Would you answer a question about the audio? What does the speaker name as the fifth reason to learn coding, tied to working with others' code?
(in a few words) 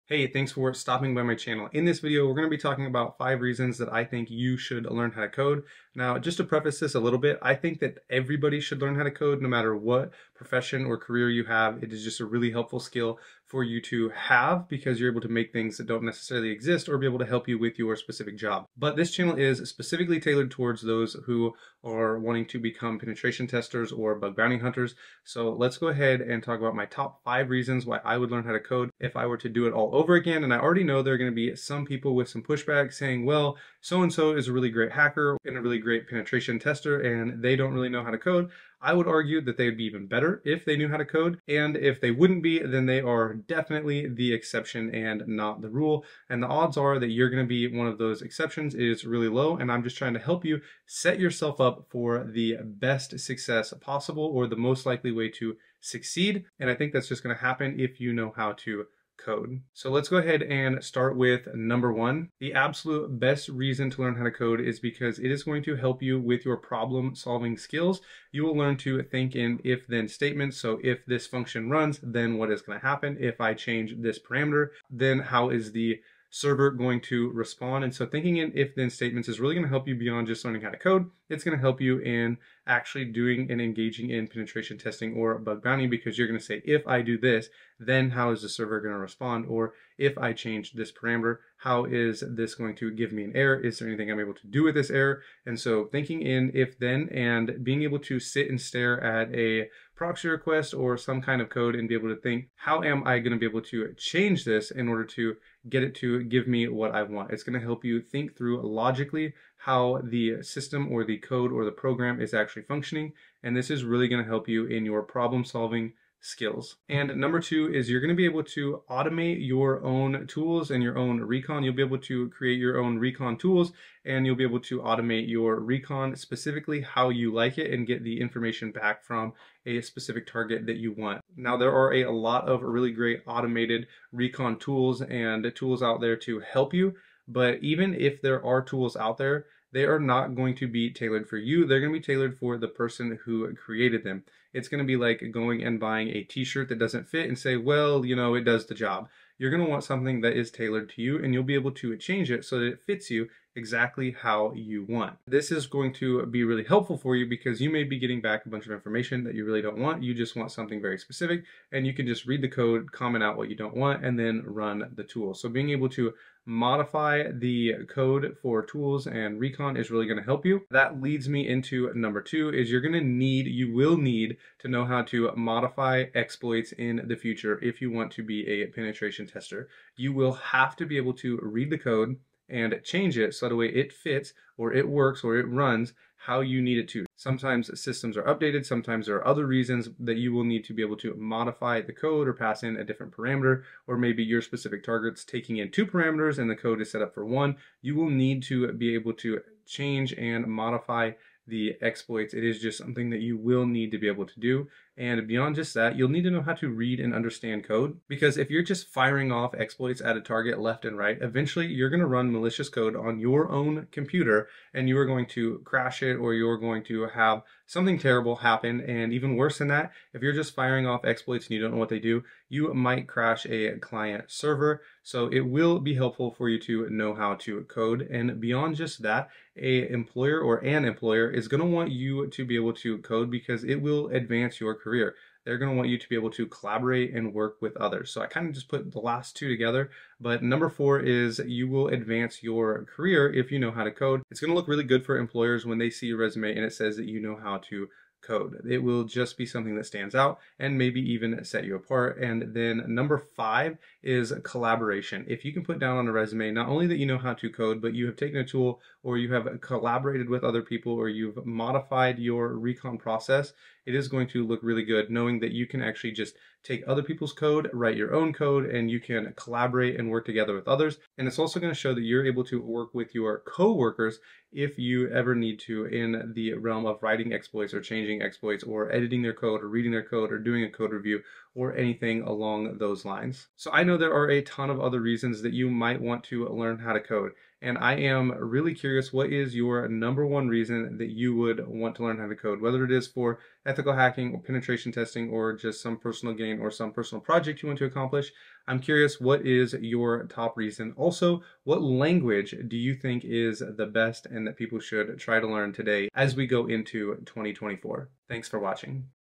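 collaboration.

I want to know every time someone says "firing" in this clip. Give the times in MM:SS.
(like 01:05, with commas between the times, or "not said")
03:28, 03:40.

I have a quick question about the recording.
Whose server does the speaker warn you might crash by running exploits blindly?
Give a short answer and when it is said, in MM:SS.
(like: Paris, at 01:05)
a client server, at 03:43.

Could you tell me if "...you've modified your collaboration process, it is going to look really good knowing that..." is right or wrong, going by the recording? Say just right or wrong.
wrong.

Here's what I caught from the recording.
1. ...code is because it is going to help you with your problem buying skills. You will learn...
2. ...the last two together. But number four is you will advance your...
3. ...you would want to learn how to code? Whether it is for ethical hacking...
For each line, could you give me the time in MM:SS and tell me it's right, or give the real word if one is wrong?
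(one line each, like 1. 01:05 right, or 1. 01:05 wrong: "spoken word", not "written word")
1. 01:04 wrong: "solving", not "buying"
2. 03:58 right
3. 04:51 right.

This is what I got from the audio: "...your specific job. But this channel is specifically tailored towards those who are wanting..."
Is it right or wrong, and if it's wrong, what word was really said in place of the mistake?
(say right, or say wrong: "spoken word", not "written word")
right.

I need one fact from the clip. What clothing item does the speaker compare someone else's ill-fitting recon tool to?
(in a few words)
t-shirt.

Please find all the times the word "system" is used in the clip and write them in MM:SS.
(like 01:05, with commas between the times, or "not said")
01:50, 03:07.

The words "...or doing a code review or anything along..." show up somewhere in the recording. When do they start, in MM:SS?
04:40.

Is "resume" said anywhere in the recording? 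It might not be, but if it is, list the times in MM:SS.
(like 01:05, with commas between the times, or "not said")
04:06, 04:16.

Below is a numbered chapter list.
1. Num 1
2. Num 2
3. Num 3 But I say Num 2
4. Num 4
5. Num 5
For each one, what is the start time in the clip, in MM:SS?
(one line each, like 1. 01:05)
1. 01:02
2. 01:56
3. 02:50
4. 03:59
5. 04:12.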